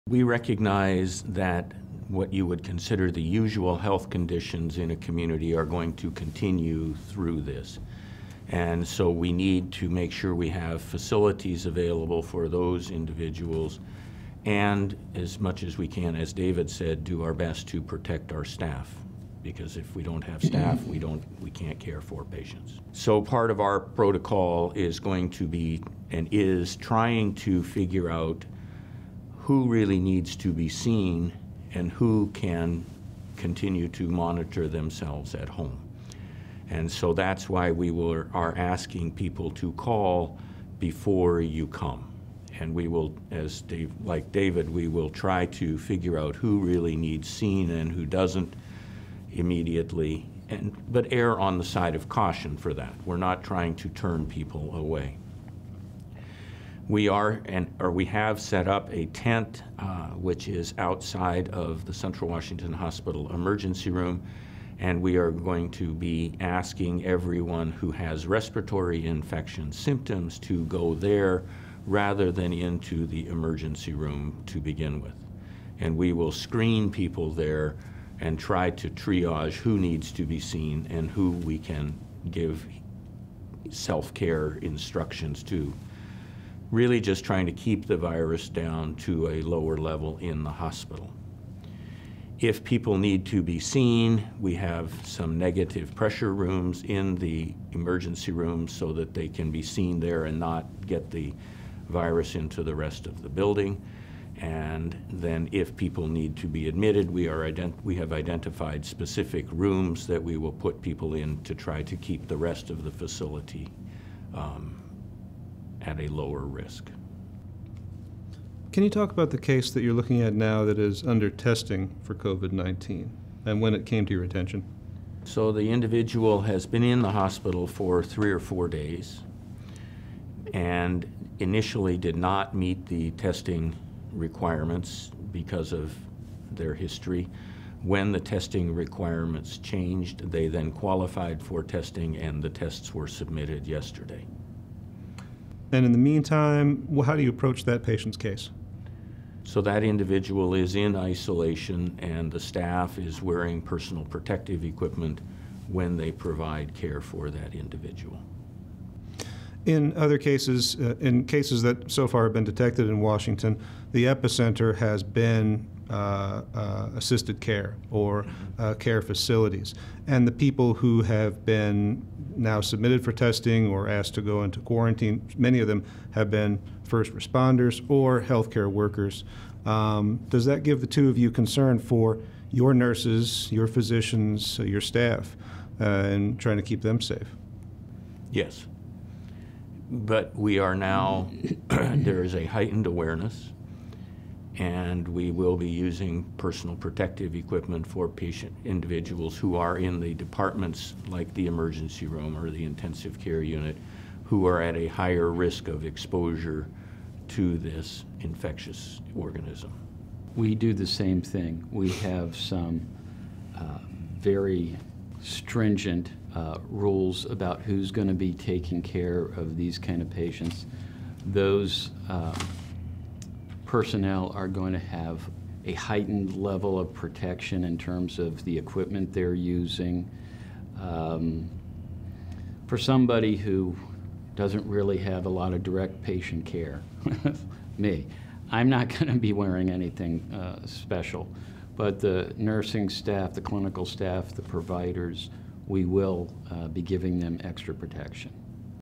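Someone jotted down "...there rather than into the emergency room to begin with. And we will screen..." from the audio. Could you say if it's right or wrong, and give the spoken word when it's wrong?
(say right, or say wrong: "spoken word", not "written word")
right.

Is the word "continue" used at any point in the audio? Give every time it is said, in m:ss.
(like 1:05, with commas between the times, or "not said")
0:06, 0:33.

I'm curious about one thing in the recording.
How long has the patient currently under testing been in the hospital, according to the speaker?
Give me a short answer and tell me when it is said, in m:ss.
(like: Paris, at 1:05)
3 or 4 days, at 2:08.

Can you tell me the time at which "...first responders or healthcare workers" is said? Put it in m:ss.
2:56.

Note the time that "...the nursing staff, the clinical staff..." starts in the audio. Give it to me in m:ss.
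4:02.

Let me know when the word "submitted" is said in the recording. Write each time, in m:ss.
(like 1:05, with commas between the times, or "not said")
2:23, 2:52.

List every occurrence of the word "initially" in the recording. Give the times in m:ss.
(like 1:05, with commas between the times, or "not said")
2:11.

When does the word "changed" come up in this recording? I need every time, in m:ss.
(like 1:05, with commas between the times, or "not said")
2:19.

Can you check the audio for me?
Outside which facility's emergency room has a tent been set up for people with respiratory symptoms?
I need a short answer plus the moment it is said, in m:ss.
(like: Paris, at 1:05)
Central Washington Hospital, at 1:01.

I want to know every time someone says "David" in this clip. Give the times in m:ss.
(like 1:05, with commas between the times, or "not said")
0:16, 0:44.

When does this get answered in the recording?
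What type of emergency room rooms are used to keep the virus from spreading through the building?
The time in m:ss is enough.
1:35.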